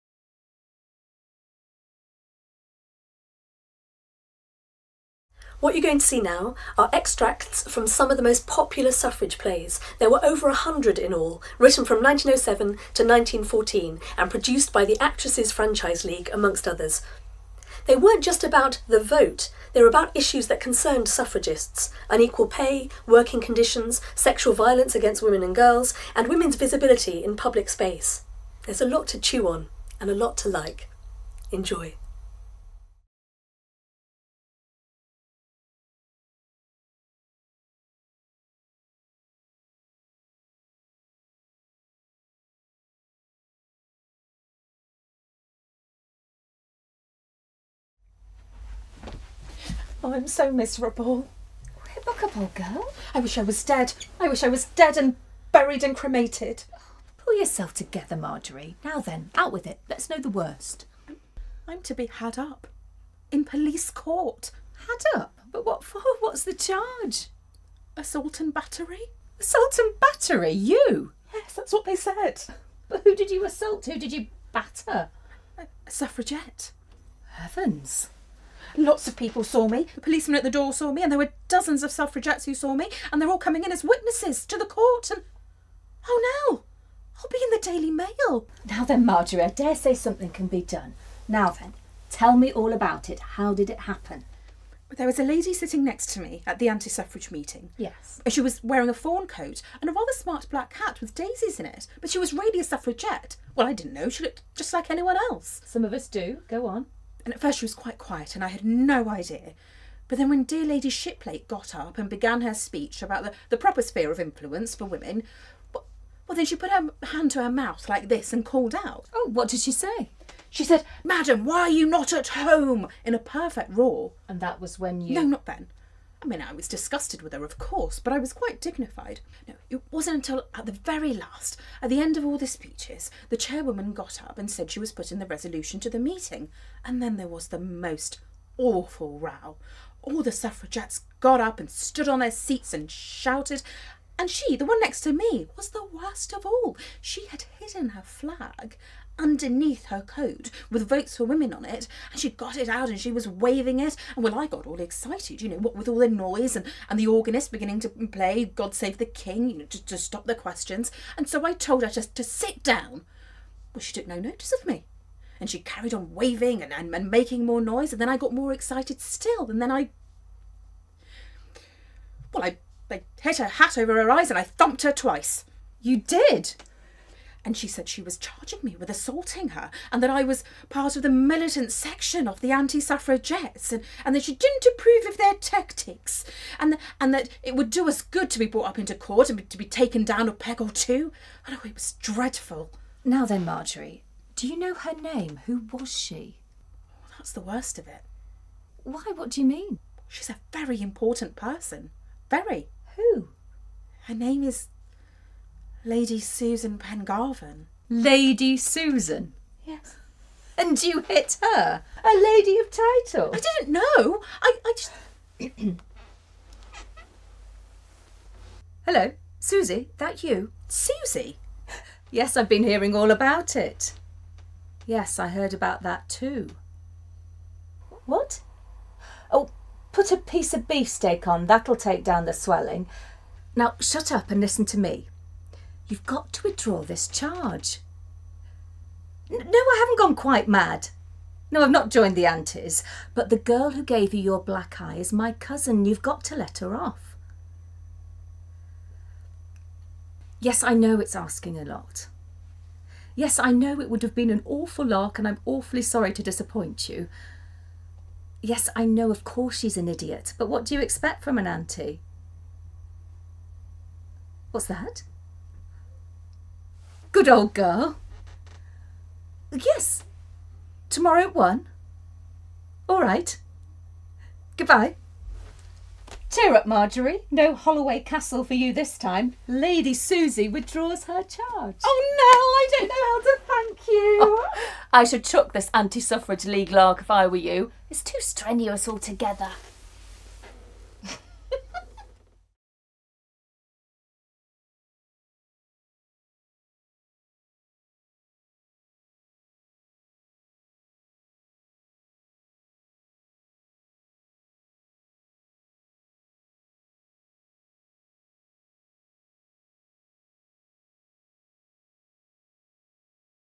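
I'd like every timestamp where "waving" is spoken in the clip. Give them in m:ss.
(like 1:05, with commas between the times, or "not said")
2:33, 2:46.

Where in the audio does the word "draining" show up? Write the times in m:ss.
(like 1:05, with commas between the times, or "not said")
not said.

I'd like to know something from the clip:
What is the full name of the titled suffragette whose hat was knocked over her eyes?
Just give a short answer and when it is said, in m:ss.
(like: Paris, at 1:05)
Lady Susan Pengarvan, at 3:25.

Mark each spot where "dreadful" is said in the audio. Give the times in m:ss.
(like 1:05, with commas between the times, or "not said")
3:11.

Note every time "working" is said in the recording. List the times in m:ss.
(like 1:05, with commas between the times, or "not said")
0:23.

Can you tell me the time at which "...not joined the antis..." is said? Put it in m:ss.
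4:01.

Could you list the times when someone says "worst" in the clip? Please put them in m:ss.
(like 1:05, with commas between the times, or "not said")
1:00, 2:25, 3:17.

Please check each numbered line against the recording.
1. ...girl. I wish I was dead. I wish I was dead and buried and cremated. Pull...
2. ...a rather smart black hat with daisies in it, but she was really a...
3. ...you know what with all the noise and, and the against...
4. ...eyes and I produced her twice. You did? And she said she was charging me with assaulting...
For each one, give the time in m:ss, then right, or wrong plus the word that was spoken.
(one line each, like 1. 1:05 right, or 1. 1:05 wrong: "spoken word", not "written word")
1. 0:52 right
2. 1:39 right
3. 2:35 wrong: "organist", not "against"
4. 2:54 wrong: "thumped", not "produced".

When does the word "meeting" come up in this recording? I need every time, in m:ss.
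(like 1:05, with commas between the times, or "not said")
1:37, 2:15.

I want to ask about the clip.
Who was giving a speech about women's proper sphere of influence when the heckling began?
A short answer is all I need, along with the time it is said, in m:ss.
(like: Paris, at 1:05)
Lady Shiplake, at 1:50.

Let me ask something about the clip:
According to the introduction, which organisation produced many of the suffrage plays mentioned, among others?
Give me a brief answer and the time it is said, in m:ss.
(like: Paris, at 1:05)
Actresses Franchise League, at 0:14.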